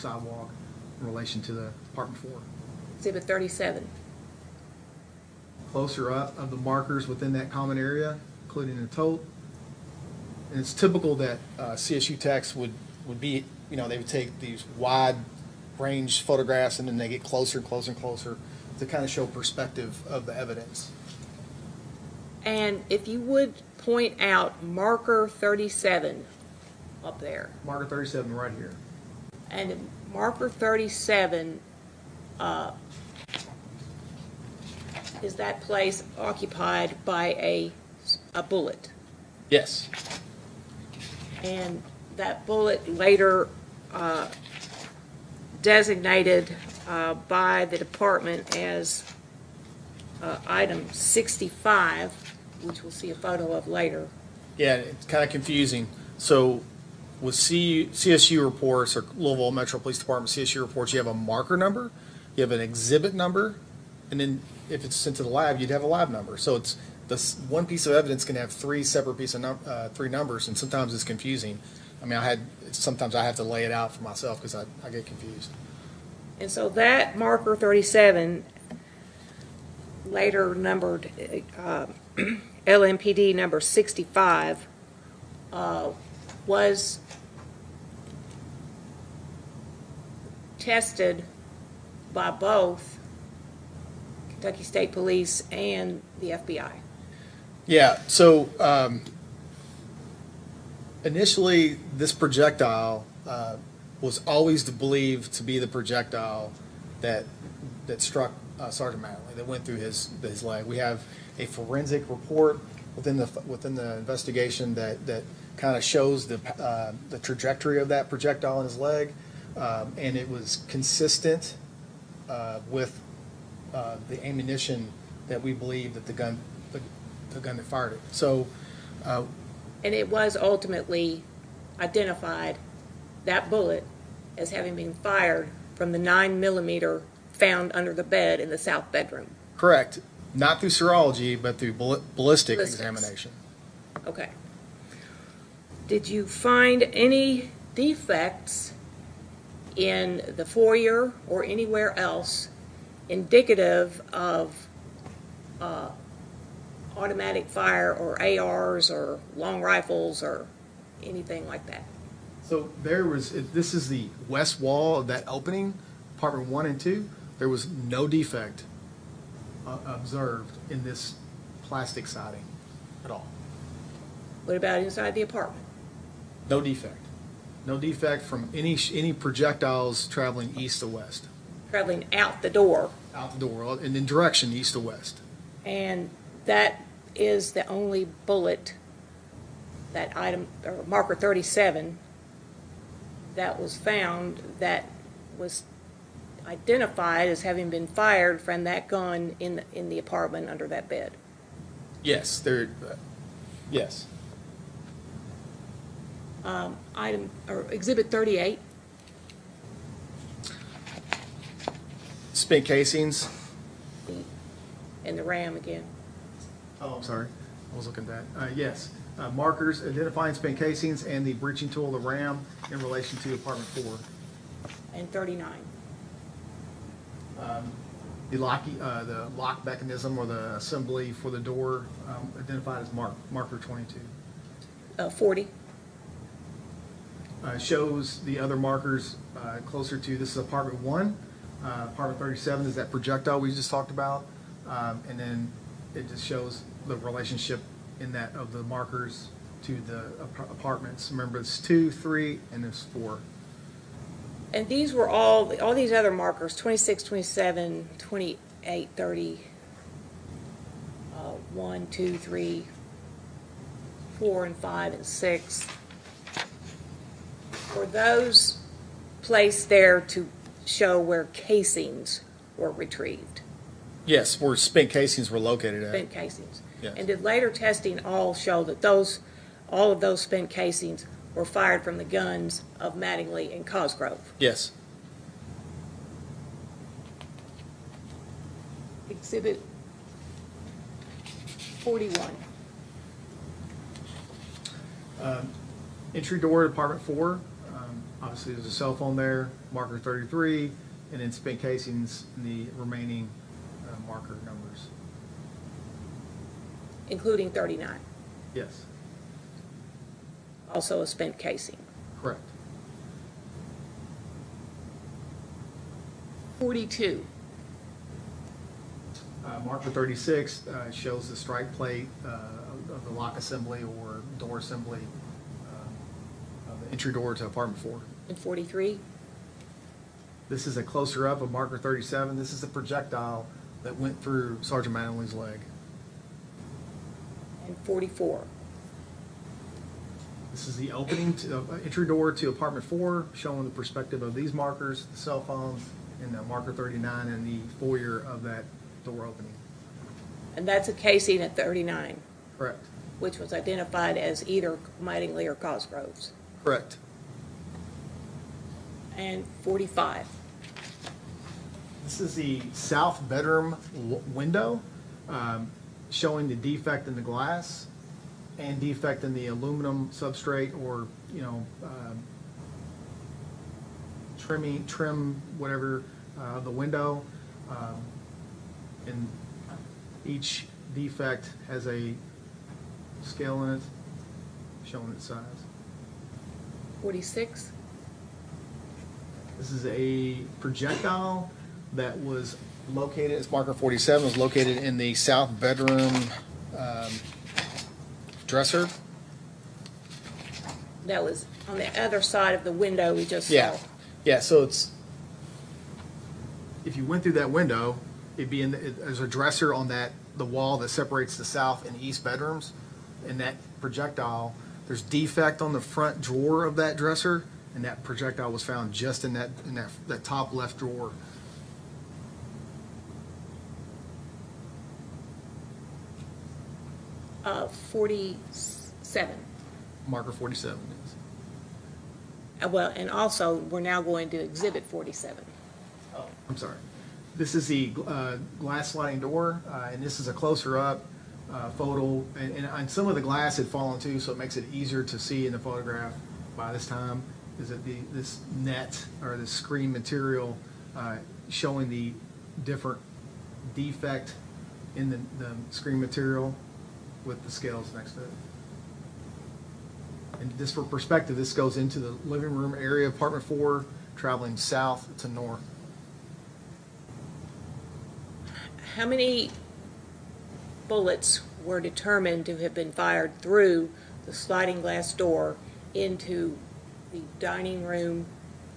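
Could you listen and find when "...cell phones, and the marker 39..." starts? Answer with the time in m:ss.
5:45.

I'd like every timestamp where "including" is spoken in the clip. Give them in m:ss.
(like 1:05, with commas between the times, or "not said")
0:08, 5:07.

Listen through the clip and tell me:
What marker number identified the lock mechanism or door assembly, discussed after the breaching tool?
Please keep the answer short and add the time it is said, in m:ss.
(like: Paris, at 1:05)
22, at 3:53.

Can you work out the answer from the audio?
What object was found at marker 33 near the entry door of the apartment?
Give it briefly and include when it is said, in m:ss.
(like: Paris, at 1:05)
cell phone, at 4:58.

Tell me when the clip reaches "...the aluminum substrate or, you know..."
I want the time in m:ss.
6:09.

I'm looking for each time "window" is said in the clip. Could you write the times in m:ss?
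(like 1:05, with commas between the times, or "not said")
6:04, 6:16, 6:42, 6:47.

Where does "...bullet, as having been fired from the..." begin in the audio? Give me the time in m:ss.
2:13.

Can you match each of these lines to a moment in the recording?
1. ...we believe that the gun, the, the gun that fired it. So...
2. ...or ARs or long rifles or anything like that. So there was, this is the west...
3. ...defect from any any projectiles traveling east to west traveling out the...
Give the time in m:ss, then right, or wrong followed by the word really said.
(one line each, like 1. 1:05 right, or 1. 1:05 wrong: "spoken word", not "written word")
1. 2:05 right
2. 2:37 right
3. 2:57 right.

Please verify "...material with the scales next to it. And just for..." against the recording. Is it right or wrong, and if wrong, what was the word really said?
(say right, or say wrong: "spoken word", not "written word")
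right.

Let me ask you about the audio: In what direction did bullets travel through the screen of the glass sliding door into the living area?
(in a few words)
south to north.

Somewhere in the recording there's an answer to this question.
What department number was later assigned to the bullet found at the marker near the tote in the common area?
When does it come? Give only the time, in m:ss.
0:50.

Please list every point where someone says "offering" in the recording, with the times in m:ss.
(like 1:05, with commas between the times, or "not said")
not said.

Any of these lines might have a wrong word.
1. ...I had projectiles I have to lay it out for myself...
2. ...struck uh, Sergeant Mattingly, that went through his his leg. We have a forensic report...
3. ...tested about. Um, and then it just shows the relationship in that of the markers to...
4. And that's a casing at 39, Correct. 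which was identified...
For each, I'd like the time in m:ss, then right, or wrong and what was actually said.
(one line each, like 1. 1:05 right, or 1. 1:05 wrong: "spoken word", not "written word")
1. 1:12 wrong: "sometimes", not "projectiles"
2. 1:48 right
3. 4:03 wrong: "talked", not "tested"
4. 5:50 right.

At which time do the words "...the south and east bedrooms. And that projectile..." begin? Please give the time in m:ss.
6:51.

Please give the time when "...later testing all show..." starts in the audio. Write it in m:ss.
4:37.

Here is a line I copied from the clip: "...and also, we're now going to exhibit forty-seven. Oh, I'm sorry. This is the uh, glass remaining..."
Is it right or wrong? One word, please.
wrong.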